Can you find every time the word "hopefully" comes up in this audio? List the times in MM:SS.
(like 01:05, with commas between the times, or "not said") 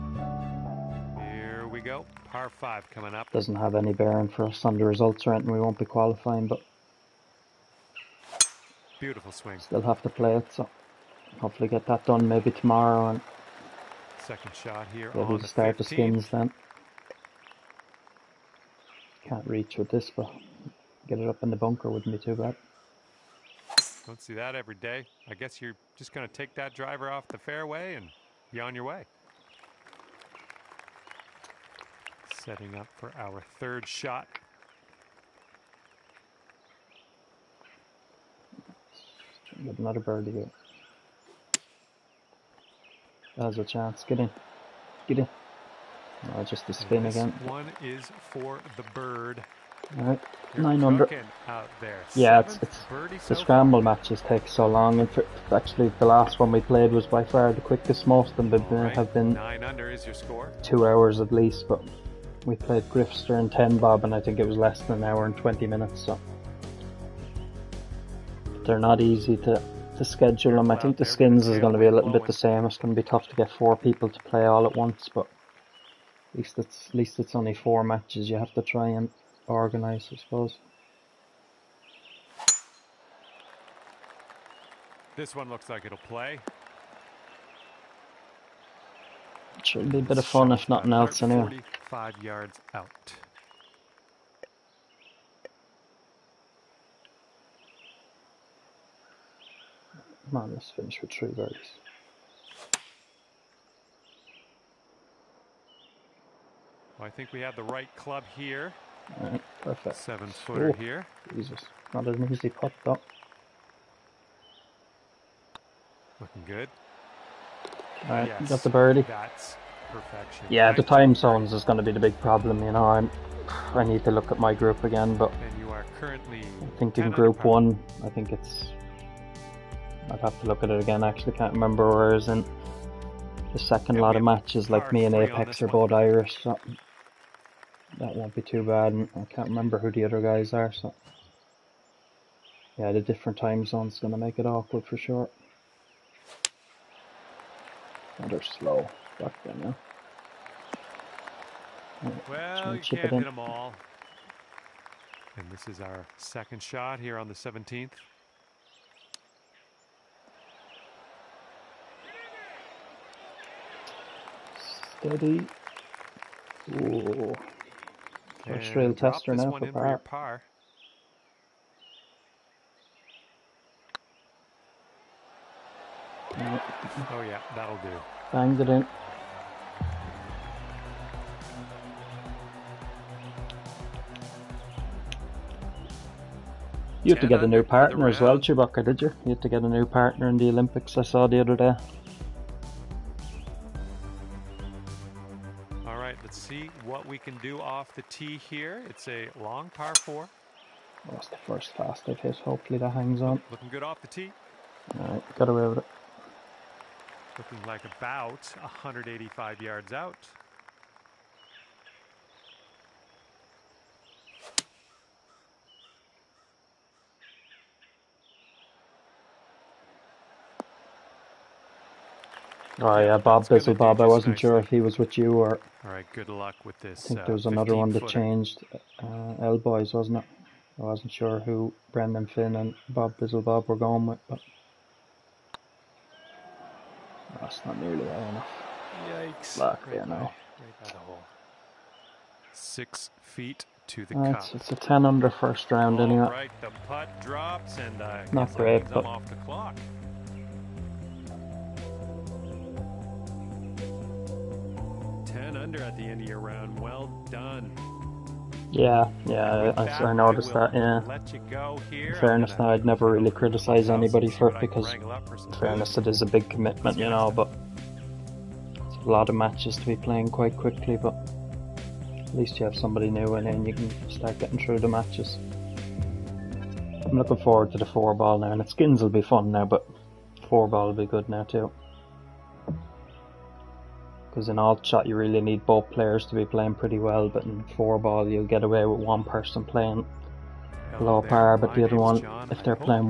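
00:11, 03:22.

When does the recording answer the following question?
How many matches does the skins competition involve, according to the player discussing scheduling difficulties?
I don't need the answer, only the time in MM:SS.
01:17.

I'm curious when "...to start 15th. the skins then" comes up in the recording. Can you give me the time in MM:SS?
00:15.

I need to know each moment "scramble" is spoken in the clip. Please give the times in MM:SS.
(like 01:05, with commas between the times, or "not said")
00:53.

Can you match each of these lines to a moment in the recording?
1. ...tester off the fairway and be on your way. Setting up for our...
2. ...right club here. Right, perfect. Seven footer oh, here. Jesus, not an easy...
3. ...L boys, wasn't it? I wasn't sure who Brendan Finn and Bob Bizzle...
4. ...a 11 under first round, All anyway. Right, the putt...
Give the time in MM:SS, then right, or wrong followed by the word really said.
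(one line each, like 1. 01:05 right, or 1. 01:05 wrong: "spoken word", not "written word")
1. 00:26 wrong: "driver", not "tester"
2. 01:47 right
3. 03:49 right
4. 04:04 wrong: "10", not "11".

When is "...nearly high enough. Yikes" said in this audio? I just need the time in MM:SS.
03:57.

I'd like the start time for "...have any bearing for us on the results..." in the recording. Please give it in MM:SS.
00:03.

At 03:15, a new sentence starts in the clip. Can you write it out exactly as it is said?
All right, let's see what we can do off the tee here.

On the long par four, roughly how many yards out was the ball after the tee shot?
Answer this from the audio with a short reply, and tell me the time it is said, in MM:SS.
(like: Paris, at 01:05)
185, at 03:28.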